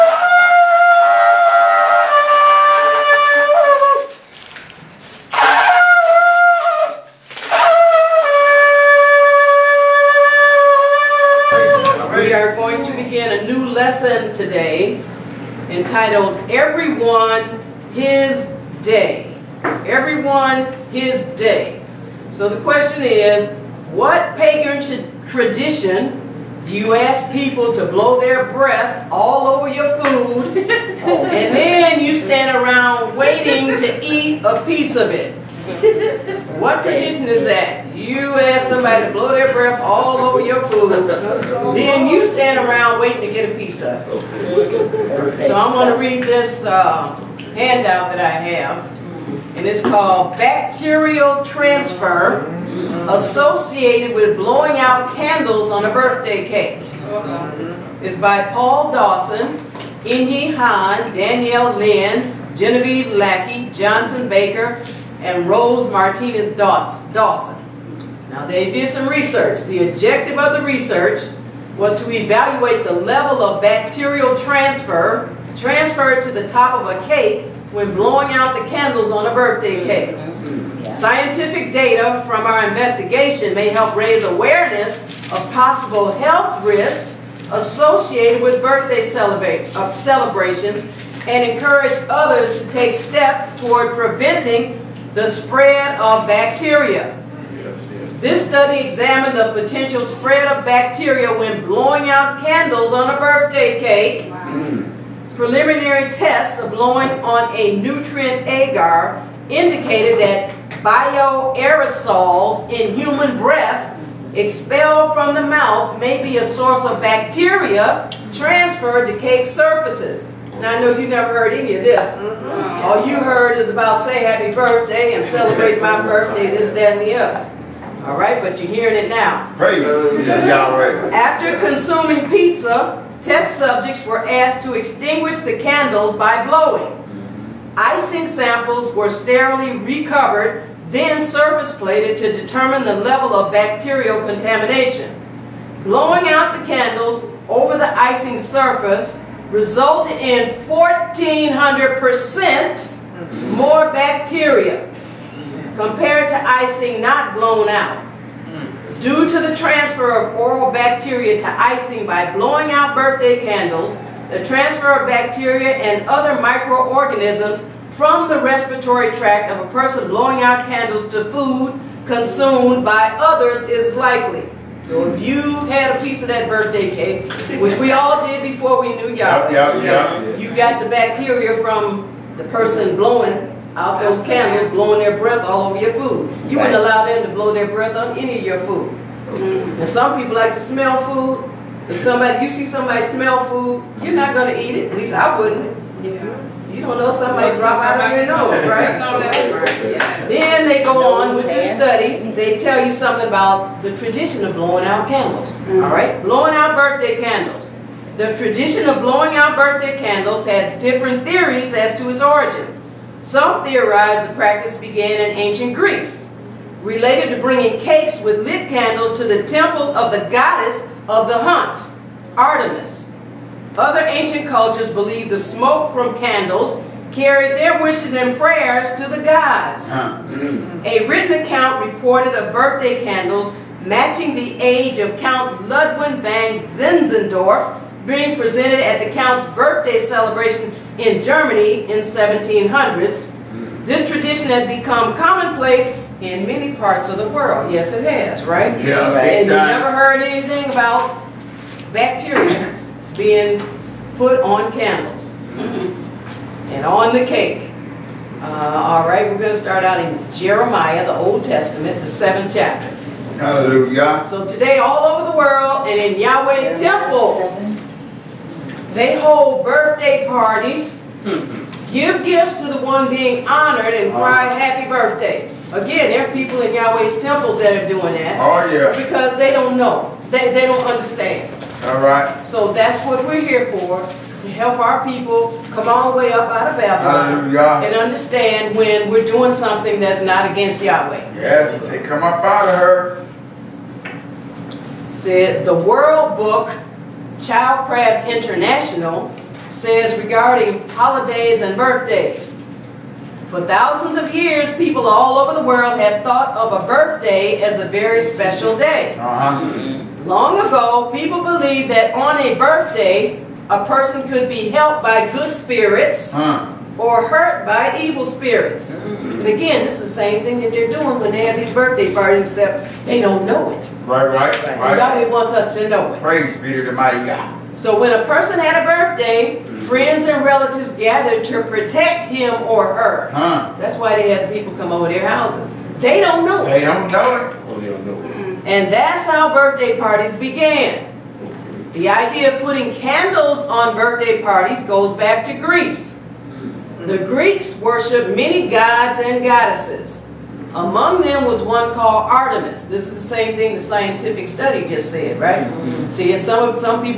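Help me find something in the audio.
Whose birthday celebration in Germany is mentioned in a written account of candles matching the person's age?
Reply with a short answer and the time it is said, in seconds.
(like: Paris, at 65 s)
Count Ludwig van Zinzendorf, at 235 s.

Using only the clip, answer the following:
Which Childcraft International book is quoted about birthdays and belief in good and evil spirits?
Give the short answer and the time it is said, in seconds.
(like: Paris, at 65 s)
World Book, at 295 s.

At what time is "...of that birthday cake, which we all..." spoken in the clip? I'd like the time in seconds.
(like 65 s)
176 s.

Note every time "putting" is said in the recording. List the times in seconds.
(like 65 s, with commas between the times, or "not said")
342 s.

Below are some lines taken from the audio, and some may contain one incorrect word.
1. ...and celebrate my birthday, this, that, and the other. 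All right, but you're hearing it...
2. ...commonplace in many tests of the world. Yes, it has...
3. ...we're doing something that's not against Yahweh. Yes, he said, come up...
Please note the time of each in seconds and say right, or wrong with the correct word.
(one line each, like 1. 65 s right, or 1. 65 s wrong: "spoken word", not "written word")
1. 125 s right
2. 245 s wrong: "parts", not "tests"
3. 289 s right.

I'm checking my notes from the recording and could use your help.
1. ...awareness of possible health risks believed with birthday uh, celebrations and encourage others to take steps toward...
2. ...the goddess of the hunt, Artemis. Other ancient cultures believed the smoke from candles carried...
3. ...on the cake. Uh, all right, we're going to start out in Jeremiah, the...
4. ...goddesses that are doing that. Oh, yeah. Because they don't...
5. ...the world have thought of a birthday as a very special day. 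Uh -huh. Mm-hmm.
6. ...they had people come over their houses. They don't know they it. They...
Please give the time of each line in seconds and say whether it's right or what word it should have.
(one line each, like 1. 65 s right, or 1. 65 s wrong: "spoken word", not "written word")
1. 84 s wrong: "associated", not "believed"
2. 220 s right
3. 256 s right
4. 277 s wrong: "temples", not "goddesses"
5. 305 s right
6. 334 s right.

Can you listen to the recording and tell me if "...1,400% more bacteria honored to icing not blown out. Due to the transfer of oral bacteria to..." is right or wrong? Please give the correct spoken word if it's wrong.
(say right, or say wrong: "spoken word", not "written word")
wrong: "compared", not "honored".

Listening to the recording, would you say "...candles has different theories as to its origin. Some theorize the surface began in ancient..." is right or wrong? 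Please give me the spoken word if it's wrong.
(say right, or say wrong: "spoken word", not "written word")
wrong: "practice", not "surface".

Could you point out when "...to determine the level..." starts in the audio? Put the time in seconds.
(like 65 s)
142 s.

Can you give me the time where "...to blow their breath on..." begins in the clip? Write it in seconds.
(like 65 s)
187 s.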